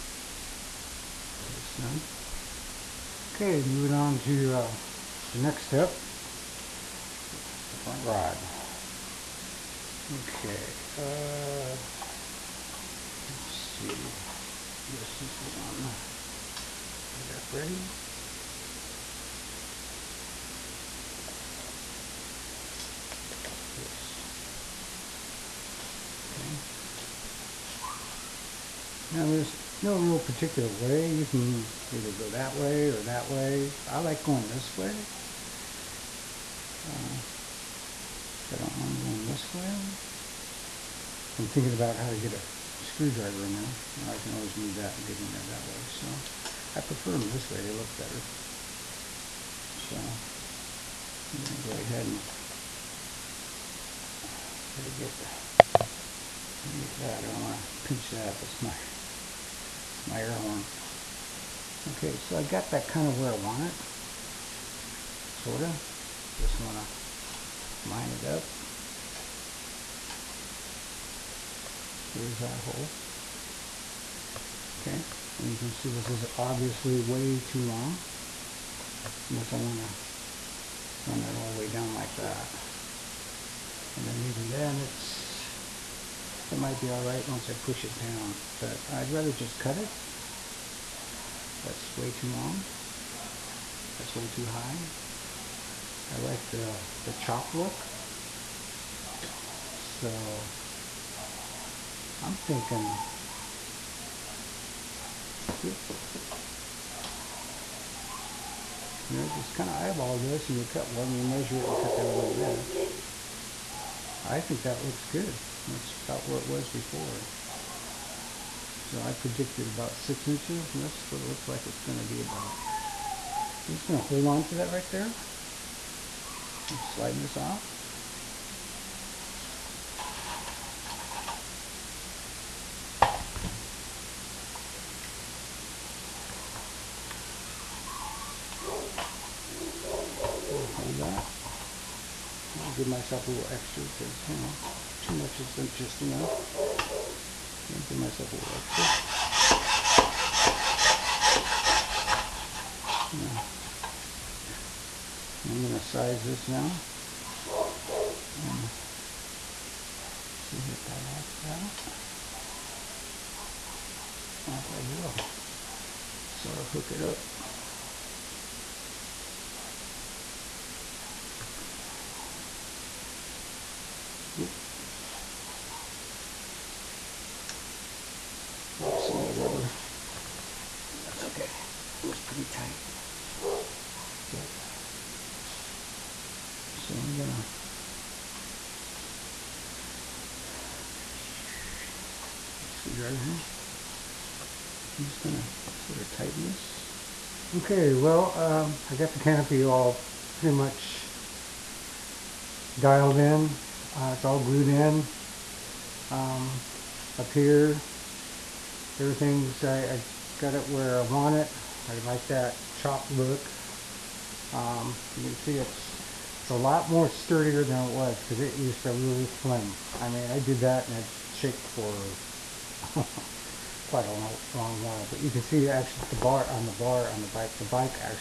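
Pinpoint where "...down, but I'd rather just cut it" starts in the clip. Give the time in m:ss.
1:27.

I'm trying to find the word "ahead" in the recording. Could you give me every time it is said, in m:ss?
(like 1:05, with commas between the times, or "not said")
0:51.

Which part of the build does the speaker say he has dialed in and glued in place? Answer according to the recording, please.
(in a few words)
the canopy.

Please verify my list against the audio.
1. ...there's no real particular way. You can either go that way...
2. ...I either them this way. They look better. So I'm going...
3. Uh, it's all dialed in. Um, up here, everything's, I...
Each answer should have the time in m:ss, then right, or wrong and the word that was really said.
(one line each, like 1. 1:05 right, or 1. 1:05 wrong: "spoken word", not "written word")
1. 0:29 right
2. 0:46 wrong: "prefer", not "either"
3. 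3:23 wrong: "glued", not "dialed".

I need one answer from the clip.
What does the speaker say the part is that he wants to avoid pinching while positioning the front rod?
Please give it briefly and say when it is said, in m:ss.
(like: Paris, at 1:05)
air horn, at 1:00.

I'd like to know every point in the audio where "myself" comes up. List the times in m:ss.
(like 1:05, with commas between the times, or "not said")
2:22, 2:27.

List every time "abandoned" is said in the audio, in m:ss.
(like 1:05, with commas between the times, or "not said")
not said.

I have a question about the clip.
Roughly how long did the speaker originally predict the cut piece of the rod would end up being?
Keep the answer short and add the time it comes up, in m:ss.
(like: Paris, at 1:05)
6 inches, at 1:59.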